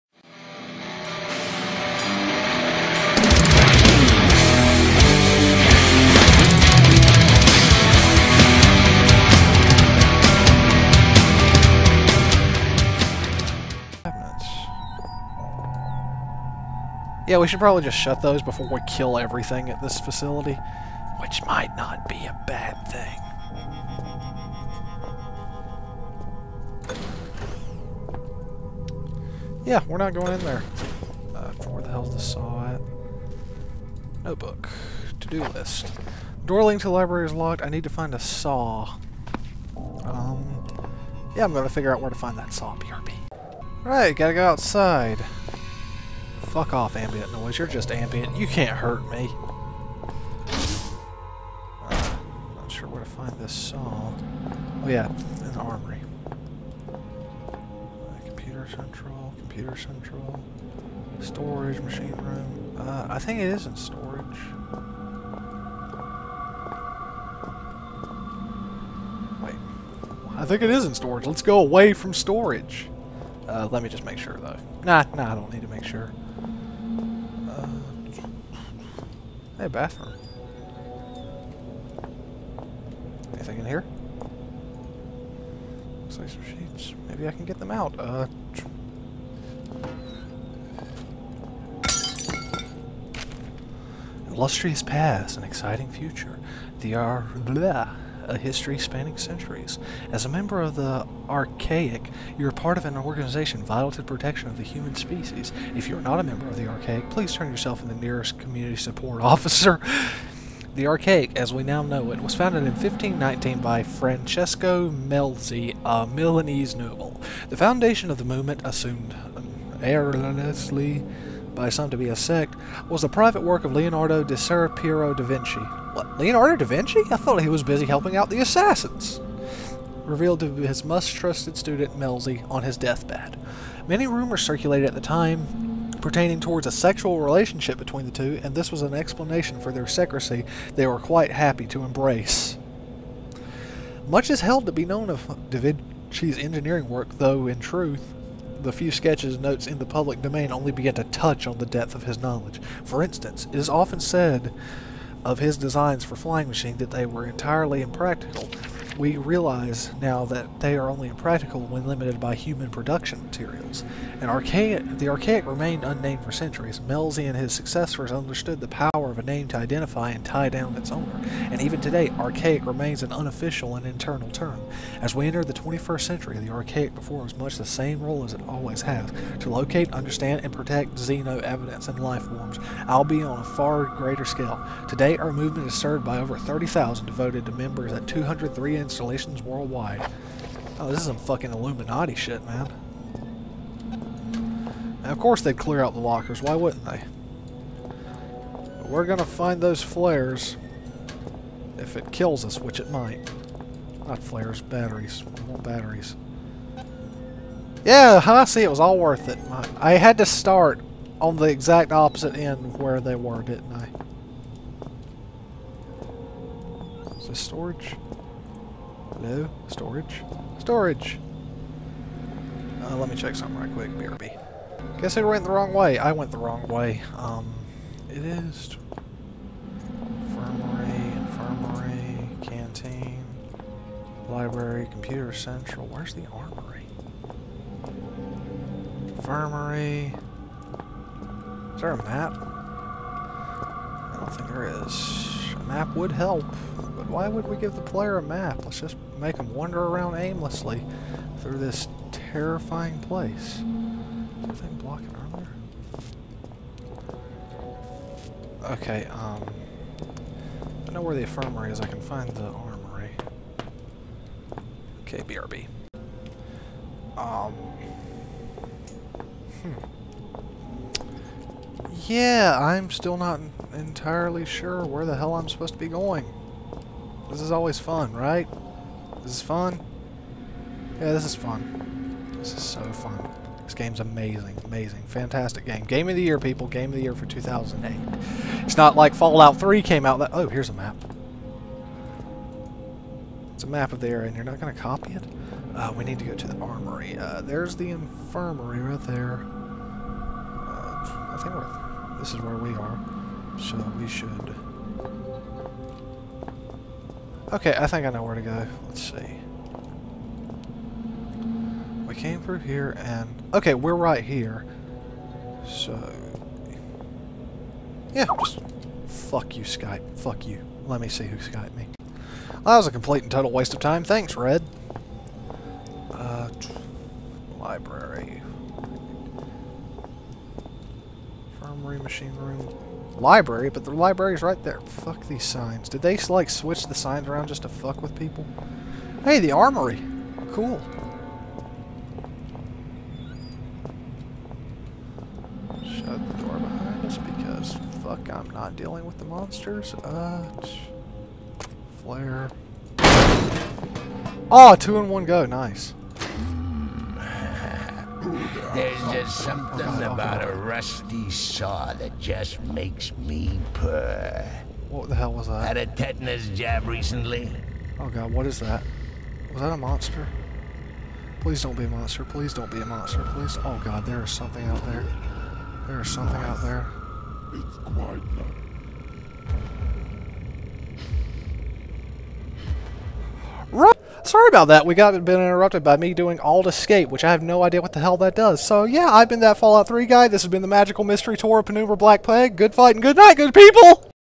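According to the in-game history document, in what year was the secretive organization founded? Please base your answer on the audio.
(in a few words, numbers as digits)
1519.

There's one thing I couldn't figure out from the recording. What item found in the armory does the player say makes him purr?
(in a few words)
rusty saw.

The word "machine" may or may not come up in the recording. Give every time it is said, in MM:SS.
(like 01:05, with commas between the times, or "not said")
01:01, 02:36, 05:31.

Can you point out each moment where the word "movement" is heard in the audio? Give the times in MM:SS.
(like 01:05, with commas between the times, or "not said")
01:58, 03:05.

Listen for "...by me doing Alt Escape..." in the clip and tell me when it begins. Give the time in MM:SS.
06:25.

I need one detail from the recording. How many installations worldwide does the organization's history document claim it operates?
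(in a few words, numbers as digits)
203.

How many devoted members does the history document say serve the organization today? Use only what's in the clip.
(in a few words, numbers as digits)
30,000.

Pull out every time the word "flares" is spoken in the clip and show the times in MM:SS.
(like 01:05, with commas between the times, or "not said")
03:19, 03:24, 05:52.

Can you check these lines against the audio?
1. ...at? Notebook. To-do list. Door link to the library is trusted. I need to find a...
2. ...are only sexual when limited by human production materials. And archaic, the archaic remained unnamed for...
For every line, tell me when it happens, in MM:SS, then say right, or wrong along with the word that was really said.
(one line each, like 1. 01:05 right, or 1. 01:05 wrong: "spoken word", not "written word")
1. 00:32 wrong: "locked", not "trusted"
2. 02:40 wrong: "impractical", not "sexual".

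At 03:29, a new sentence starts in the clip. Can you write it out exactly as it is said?
My, I had to start on the exact opposite end where they were, didn't I?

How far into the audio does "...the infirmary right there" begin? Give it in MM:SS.
04:57.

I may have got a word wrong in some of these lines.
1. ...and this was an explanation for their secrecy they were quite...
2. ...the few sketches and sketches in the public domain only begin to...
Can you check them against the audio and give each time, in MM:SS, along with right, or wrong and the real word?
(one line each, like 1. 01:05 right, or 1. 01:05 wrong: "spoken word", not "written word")
1. 02:18 right
2. 02:28 wrong: "notes", not "sketches".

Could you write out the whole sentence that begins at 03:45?
Guess I went the wrong way.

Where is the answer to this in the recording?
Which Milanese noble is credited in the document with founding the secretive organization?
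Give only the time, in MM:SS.
01:53.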